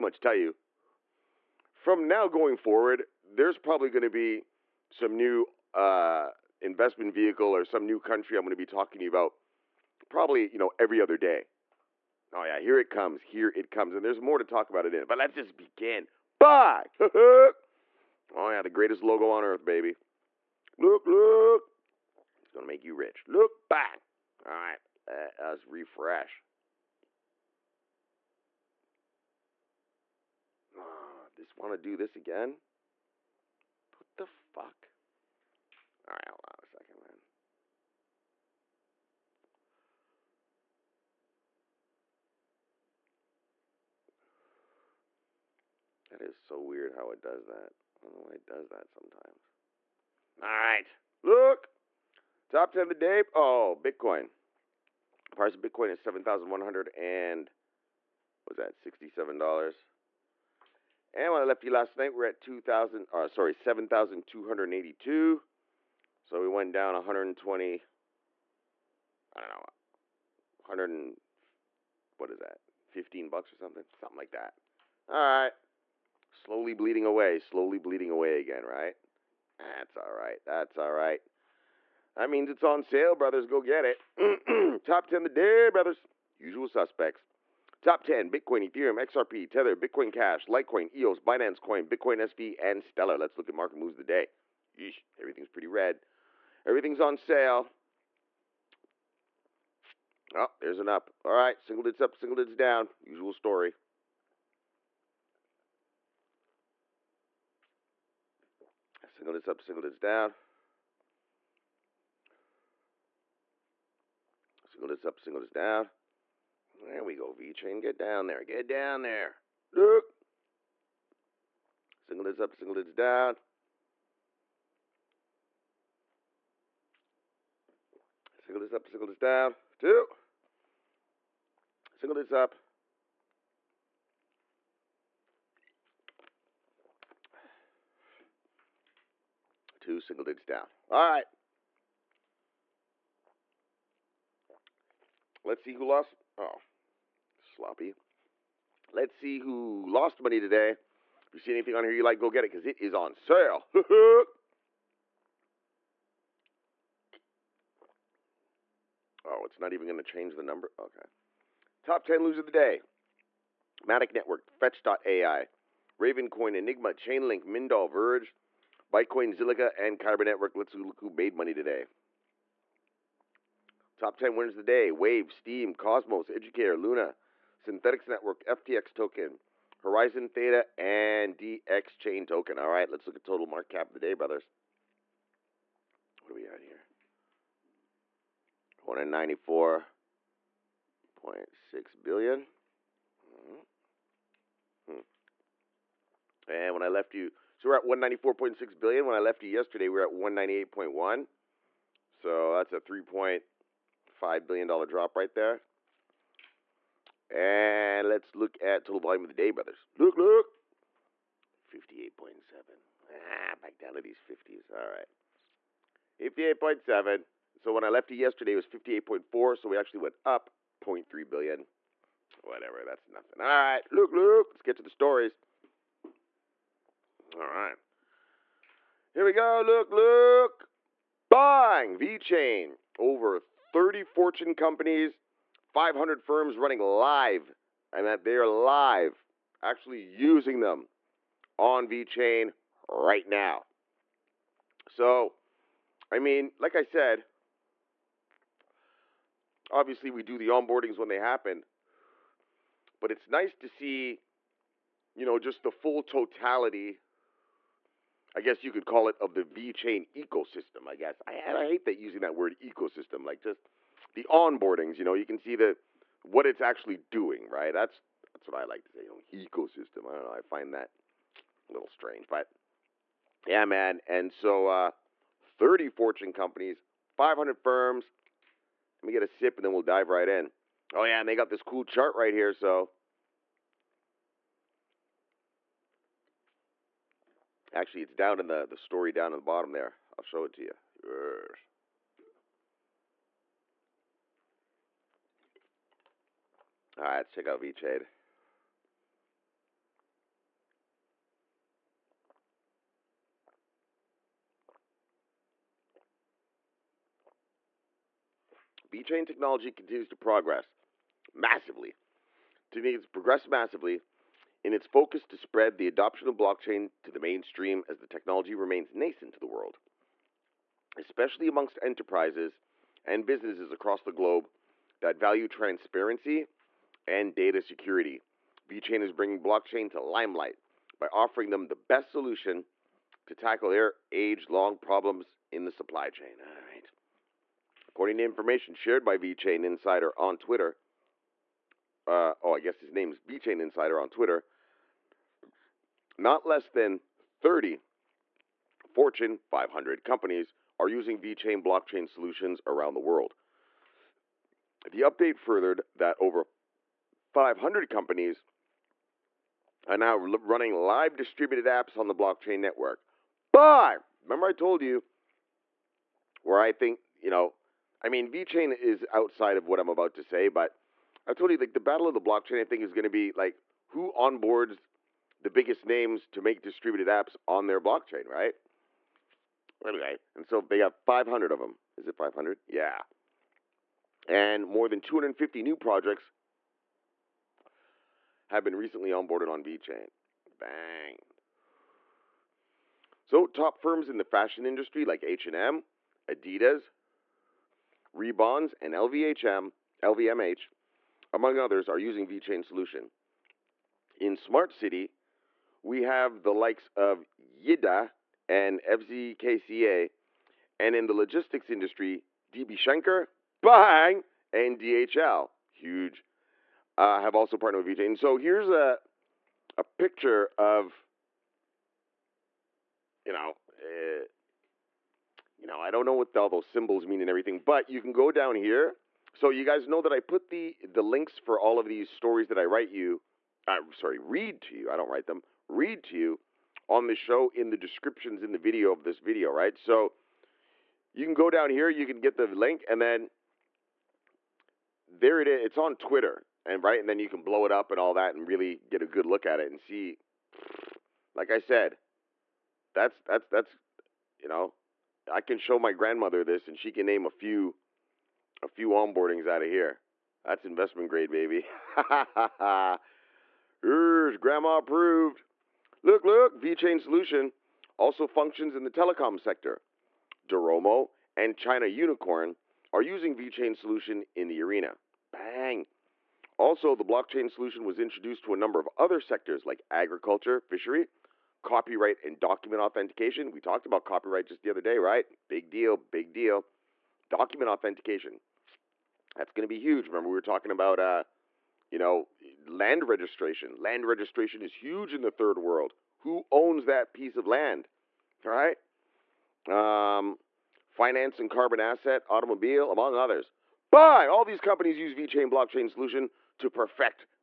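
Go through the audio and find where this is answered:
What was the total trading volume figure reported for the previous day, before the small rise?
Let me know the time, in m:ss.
3:38.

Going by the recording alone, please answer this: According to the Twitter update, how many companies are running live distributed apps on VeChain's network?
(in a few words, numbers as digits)
Over 500.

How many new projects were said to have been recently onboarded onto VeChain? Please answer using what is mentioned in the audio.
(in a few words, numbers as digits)
More than 250.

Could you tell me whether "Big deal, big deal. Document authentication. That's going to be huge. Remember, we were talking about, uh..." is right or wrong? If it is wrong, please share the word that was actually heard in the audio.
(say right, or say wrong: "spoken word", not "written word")
right.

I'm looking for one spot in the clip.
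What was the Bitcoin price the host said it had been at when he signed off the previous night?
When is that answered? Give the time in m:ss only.
1:03.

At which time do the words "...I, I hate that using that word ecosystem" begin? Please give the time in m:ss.
4:21.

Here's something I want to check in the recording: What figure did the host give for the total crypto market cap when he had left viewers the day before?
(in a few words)
198.1 billion.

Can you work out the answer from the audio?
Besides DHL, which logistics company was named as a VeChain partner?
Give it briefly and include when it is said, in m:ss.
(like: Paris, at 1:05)
DB Schenker, at 6:52.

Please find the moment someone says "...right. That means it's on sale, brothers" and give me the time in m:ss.
1:20.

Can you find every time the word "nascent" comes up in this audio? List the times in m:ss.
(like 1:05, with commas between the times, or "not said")
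5:18.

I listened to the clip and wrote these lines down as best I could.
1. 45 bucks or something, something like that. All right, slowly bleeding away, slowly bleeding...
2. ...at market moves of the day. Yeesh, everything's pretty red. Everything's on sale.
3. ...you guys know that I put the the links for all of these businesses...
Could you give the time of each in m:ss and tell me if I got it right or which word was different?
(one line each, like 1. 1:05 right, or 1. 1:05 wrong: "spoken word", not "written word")
1. 1:12 wrong: "15", not "45"
2. 1:33 right
3. 7:09 wrong: "stories", not "businesses".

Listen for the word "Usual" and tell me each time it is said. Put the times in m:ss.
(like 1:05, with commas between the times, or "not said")
1:26, 1:43.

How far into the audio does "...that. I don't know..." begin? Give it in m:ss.
0:47.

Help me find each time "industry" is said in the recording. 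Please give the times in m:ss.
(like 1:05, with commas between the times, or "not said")
6:34, 6:51.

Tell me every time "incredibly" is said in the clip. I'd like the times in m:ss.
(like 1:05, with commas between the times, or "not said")
not said.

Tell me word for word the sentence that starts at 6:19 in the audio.
Anyway, and so they have 500 of them.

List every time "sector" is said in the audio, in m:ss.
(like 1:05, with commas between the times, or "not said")
7:49, 7:59.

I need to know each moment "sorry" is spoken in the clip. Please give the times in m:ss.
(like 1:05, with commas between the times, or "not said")
1:03, 7:13.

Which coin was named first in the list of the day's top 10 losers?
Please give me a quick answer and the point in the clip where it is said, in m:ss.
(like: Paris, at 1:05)
Matic Network, at 2:43.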